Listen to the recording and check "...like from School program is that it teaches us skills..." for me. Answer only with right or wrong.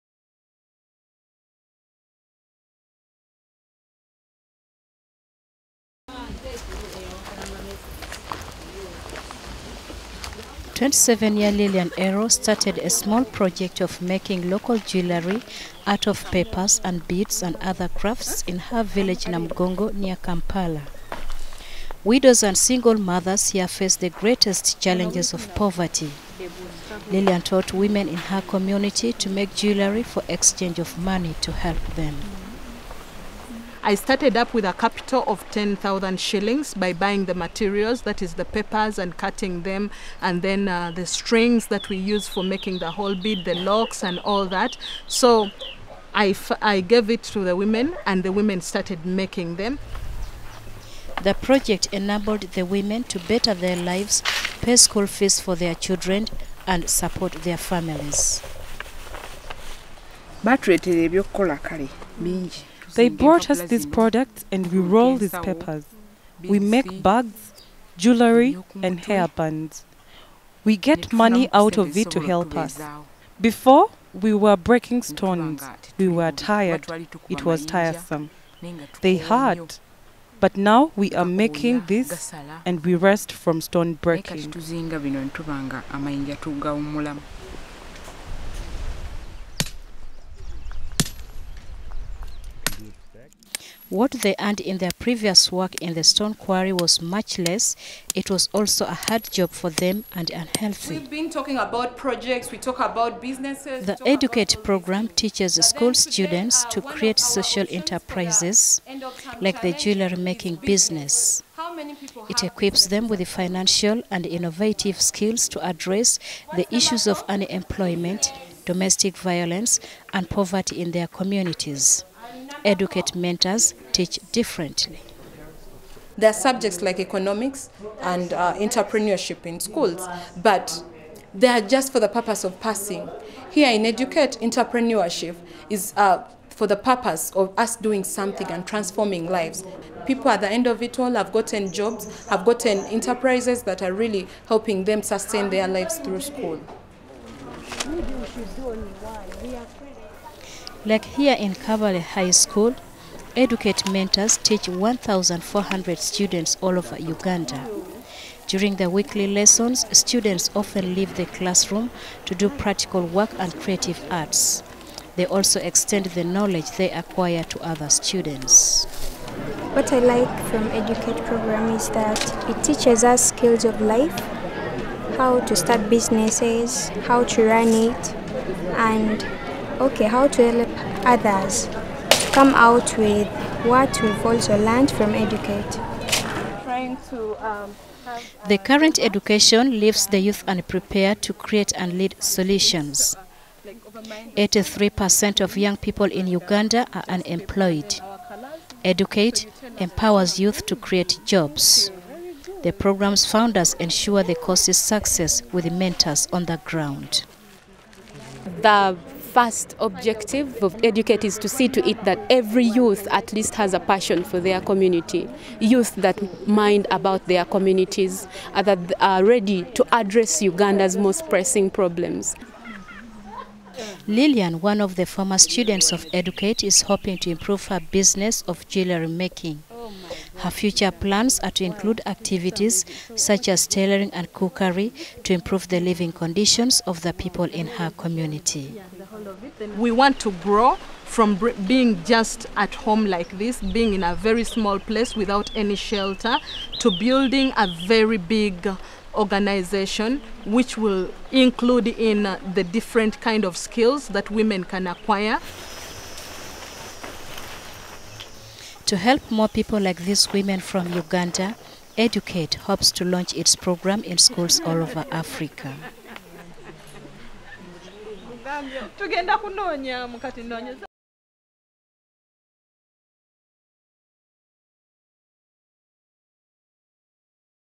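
wrong.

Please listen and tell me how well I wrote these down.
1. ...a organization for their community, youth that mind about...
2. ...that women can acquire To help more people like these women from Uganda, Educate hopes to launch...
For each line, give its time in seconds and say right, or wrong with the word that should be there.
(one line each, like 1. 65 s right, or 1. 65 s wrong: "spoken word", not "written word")
1. 213 s wrong: "passion", not "organization"
2. 254 s right.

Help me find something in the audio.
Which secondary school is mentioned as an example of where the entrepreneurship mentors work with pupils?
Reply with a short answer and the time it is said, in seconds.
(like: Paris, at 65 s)
Kabale High School, at 151 s.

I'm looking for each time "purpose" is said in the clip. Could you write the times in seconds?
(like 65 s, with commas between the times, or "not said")
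132 s, 136 s.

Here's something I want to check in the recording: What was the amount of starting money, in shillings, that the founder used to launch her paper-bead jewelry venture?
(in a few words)
10,000 shillings.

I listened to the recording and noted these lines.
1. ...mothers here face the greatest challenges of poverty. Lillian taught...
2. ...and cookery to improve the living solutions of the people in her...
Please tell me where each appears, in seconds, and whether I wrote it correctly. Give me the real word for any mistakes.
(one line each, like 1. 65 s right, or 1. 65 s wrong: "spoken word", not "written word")
1. 22 s right
2. 234 s wrong: "conditions", not "solutions".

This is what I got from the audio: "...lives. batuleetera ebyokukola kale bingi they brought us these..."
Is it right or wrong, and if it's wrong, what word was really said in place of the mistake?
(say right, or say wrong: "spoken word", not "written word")
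wrong: "families", not "lives".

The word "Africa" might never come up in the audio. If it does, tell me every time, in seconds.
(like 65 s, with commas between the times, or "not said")
265 s.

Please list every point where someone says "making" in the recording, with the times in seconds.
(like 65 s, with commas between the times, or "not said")
14 s, 42 s, 49 s, 81 s, 110 s, 229 s.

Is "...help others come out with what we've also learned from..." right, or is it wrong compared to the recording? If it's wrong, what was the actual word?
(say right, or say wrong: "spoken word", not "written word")
right.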